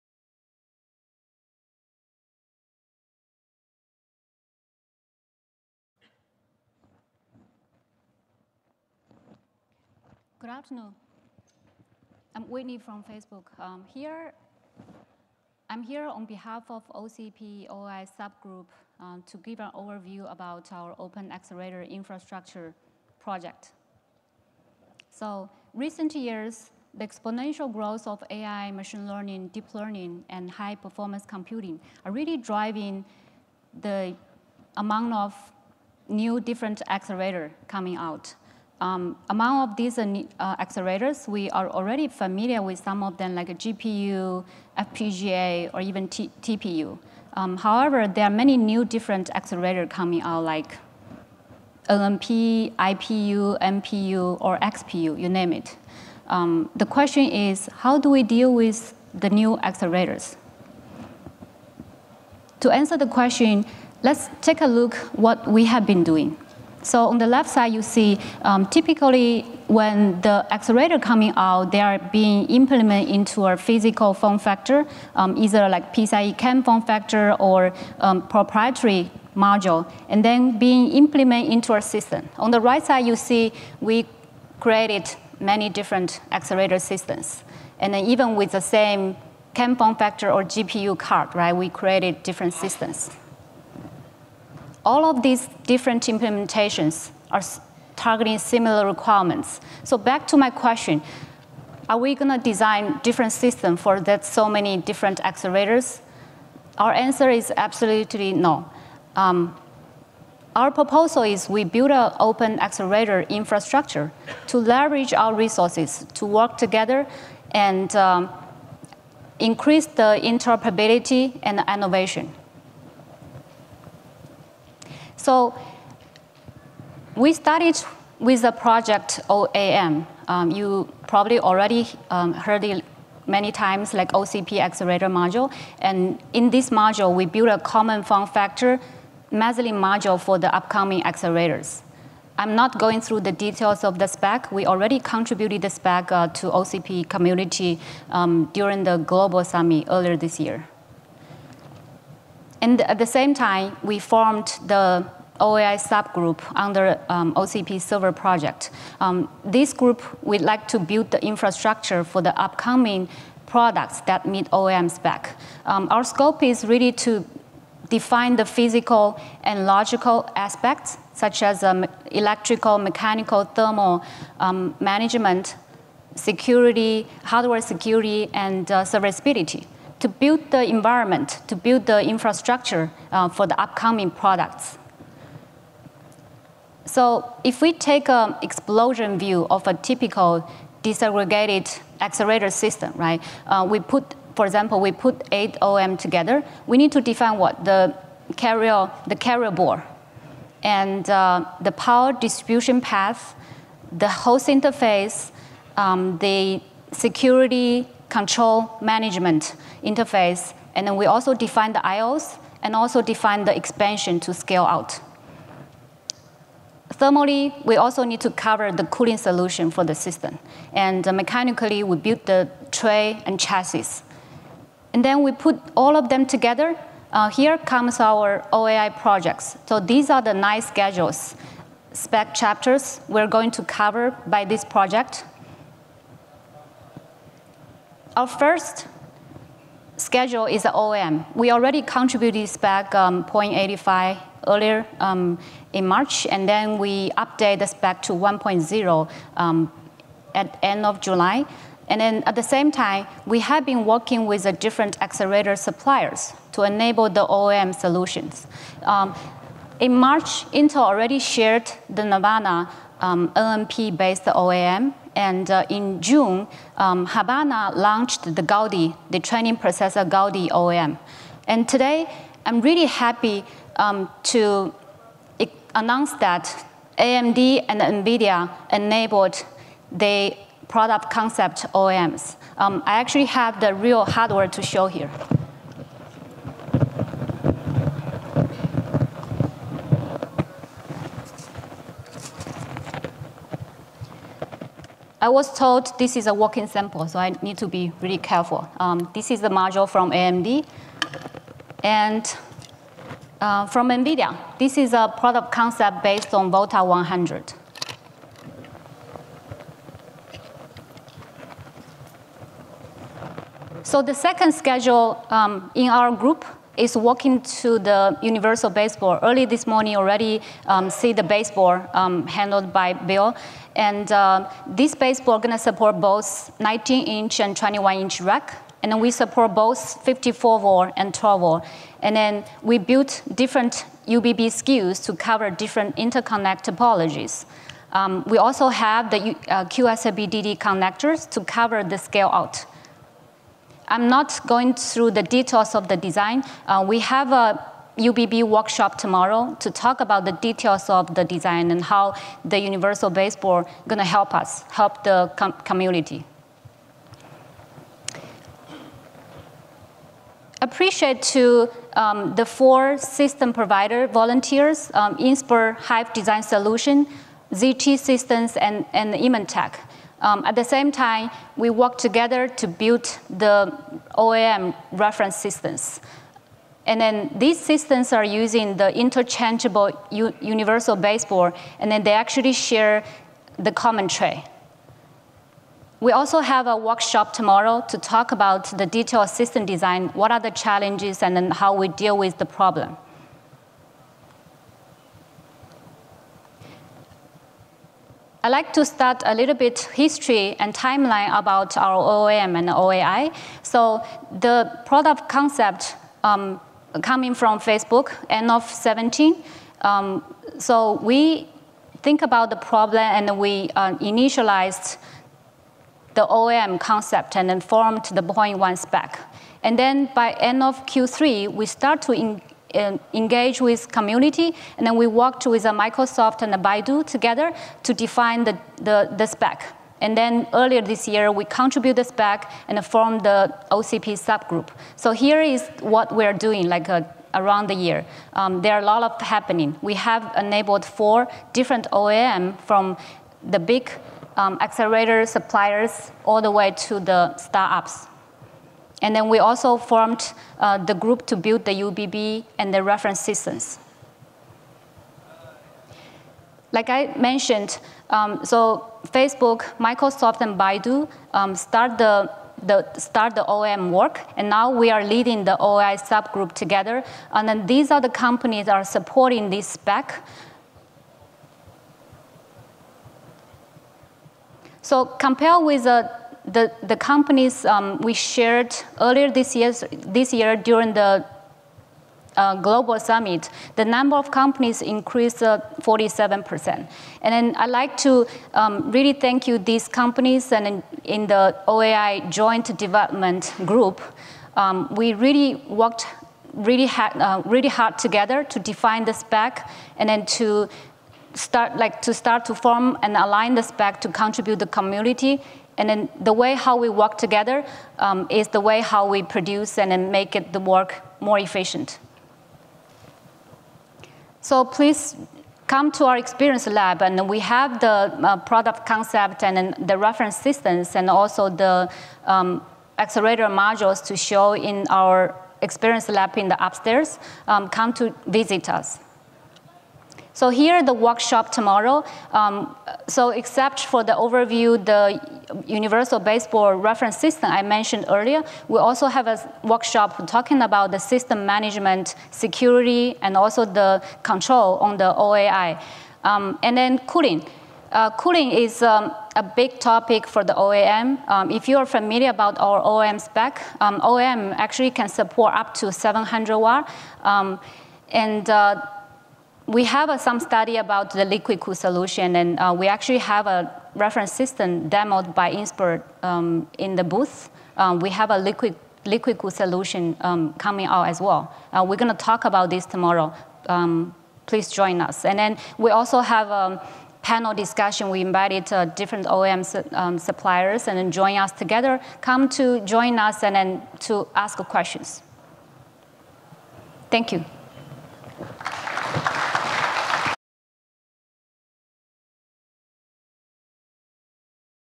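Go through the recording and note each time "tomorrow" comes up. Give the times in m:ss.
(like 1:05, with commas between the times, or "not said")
5:48, 6:27, 8:51, 9:32.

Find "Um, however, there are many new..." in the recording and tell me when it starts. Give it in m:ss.
0:47.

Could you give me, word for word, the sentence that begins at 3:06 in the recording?
So if we take an explosion view of a typical disaggregated accelerator system, right?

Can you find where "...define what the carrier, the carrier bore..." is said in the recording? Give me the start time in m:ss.
3:16.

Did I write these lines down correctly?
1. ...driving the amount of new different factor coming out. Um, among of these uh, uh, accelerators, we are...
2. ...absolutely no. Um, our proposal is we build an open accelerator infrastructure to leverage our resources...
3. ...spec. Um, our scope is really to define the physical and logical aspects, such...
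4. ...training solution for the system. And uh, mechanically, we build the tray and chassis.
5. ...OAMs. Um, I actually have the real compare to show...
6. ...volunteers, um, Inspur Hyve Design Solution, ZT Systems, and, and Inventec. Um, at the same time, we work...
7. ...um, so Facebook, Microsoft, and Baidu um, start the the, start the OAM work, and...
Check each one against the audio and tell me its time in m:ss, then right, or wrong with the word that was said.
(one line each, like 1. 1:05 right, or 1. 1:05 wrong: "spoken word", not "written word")
1. 0:32 wrong: "accelerator", not "factor"
2. 1:47 right
3. 2:44 right
4. 3:38 wrong: "cooling", not "training"
5. 4:41 wrong: "hardware", not "compare"
6. 6:04 right
7. 7:38 right.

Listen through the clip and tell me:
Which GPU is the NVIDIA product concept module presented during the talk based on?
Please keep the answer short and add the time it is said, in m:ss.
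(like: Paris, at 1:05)
Volta 100, at 5:06.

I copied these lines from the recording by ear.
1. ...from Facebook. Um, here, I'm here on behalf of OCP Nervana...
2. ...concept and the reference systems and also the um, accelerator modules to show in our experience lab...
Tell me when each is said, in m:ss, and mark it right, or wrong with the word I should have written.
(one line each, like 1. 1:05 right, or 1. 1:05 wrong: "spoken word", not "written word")
1. 0:12 wrong: "OAI", not "Nervana"
2. 8:38 right.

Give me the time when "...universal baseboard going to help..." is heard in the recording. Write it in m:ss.
5:52.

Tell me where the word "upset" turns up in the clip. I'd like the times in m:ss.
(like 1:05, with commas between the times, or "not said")
not said.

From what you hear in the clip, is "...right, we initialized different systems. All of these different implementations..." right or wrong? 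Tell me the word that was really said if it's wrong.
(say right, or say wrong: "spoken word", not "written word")
wrong: "created", not "initialized".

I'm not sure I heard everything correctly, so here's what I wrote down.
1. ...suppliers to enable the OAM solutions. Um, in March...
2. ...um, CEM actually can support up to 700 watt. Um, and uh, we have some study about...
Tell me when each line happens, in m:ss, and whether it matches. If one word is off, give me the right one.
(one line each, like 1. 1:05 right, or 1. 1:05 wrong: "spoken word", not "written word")
1. 4:15 right
2. 9:13 wrong: "OAM", not "CEM".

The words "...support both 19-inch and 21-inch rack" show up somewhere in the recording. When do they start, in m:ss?
5:25.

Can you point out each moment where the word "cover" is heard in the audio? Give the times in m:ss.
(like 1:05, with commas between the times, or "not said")
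3:38, 3:53, 5:35, 5:41.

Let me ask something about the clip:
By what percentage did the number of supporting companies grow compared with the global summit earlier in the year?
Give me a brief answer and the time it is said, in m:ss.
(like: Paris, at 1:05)
47%, at 8:05.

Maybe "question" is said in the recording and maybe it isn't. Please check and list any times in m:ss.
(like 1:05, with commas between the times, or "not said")
0:56, 1:03, 1:40, 9:44.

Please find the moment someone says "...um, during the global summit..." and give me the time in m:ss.
2:28.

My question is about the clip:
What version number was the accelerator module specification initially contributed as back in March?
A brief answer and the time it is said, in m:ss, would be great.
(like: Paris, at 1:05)
0.85, at 4:03.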